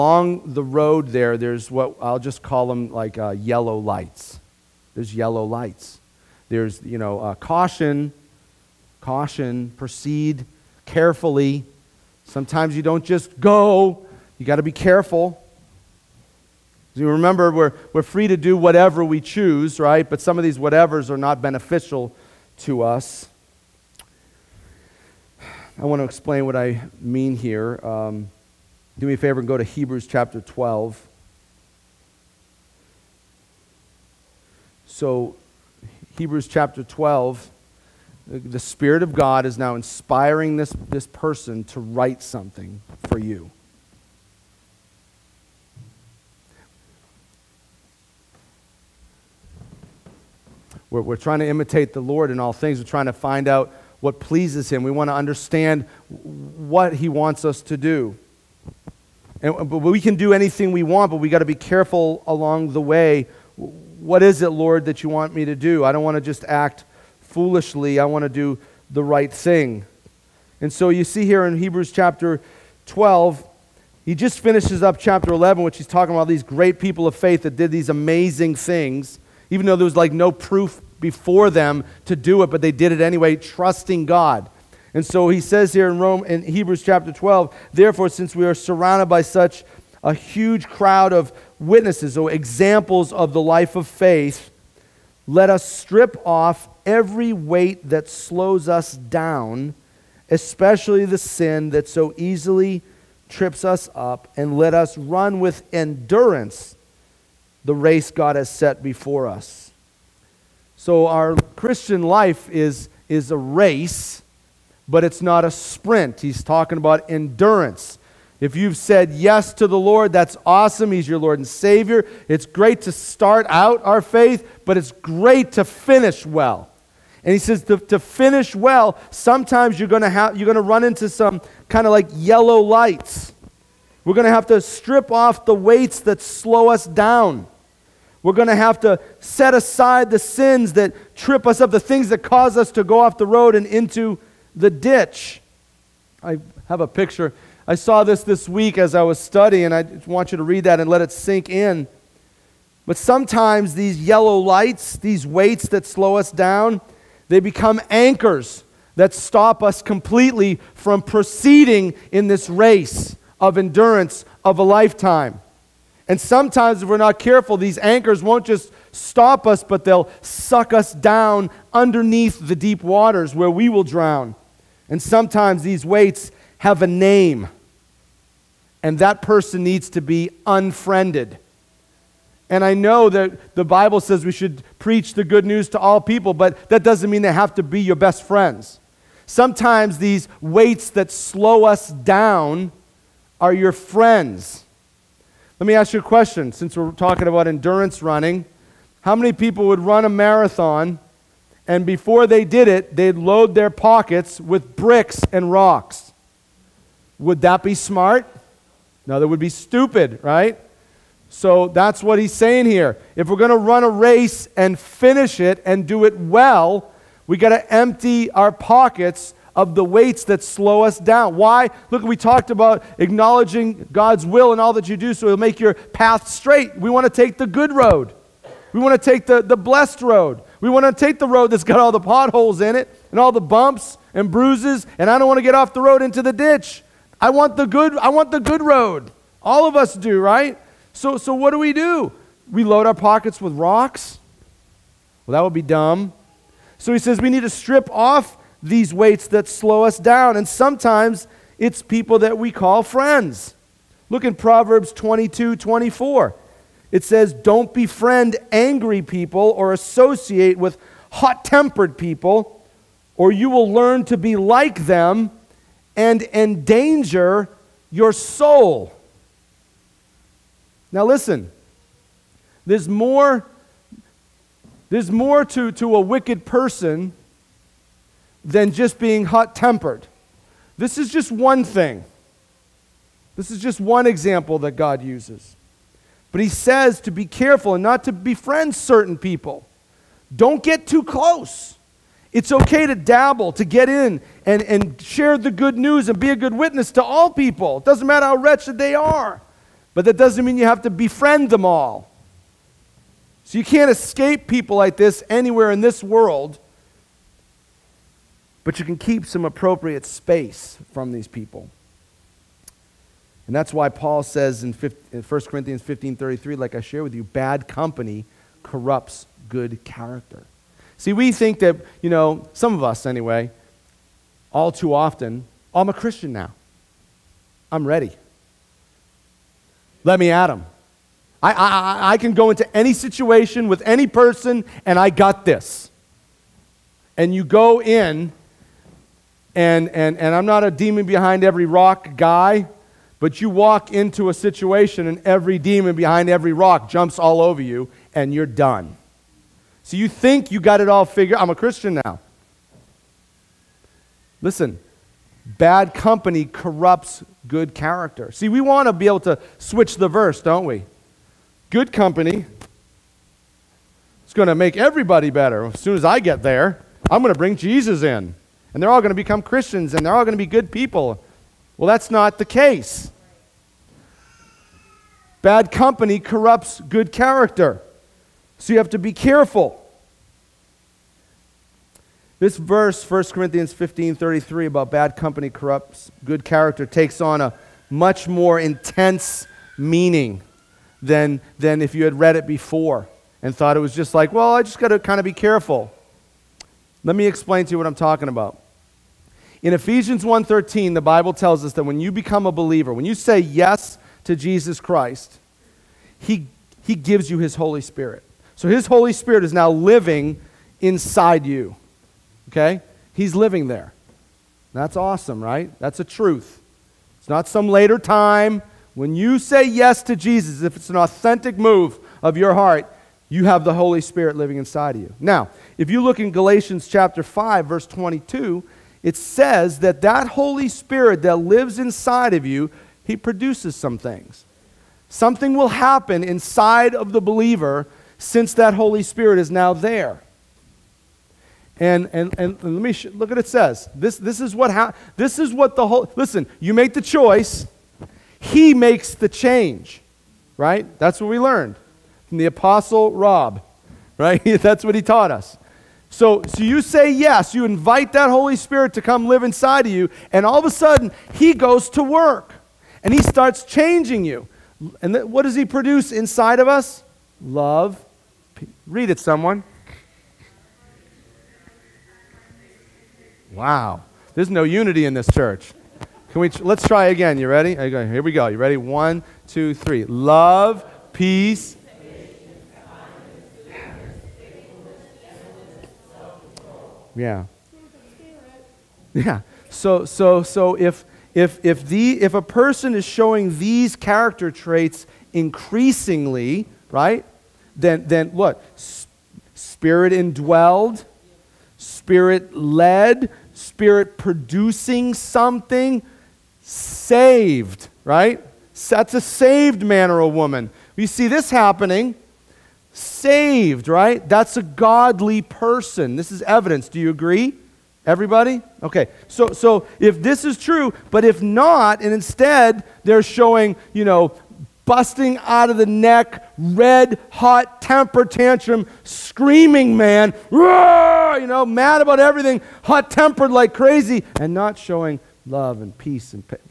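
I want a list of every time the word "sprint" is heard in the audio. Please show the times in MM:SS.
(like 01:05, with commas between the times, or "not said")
01:55.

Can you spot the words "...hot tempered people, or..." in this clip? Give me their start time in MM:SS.
04:21.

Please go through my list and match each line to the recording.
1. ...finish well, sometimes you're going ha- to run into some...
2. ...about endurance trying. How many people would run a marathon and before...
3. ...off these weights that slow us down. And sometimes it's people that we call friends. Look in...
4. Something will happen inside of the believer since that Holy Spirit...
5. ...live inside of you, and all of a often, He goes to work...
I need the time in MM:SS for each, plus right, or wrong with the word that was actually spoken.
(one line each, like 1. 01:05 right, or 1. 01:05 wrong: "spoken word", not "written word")
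1. 02:07 right
2. 03:17 wrong: "running", not "trying"
3. 04:07 right
4. 07:15 right
5. 07:39 wrong: "sudden", not "often".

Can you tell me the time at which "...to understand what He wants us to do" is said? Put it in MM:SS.
00:55.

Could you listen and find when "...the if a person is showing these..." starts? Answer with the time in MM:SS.
08:11.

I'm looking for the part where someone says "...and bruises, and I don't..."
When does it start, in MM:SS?
03:54.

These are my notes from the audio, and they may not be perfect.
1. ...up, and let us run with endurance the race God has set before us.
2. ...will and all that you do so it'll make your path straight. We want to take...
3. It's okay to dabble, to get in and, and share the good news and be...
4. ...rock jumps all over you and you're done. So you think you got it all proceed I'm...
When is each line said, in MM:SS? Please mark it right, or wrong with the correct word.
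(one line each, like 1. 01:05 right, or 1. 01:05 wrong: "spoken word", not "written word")
1. 01:43 right
2. 03:44 right
3. 04:52 right
4. 05:46 wrong: "figured", not "proceed".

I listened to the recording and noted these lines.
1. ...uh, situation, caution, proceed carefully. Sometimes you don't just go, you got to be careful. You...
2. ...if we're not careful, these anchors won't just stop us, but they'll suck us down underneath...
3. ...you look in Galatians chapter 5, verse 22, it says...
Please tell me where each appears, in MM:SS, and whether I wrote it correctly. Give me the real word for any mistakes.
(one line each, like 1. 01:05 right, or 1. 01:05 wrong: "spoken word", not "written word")
1. 00:07 wrong: "caution", not "situation"
2. 02:46 right
3. 07:05 right.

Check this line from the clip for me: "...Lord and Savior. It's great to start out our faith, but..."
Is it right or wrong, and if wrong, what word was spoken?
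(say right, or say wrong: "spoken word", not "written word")
right.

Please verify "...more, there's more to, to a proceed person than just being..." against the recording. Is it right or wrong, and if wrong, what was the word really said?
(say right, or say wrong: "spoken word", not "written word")
wrong: "wicked", not "proceed".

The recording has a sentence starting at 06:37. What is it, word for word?
Let me explain to you what I'm talking about.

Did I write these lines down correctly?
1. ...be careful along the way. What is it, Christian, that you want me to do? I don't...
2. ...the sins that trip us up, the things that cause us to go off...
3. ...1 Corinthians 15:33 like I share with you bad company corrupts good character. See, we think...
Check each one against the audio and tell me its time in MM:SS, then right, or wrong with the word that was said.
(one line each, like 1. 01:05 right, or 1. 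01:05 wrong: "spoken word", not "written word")
1. 01:01 wrong: "Lord", not "Christian"
2. 02:20 right
3. 05:14 right.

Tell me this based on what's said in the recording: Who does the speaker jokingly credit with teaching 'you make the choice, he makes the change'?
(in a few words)
The Apostle Rob.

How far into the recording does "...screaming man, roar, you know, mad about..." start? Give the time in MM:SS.
08:49.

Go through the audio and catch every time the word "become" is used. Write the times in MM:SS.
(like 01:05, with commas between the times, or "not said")
02:37, 06:09, 06:42.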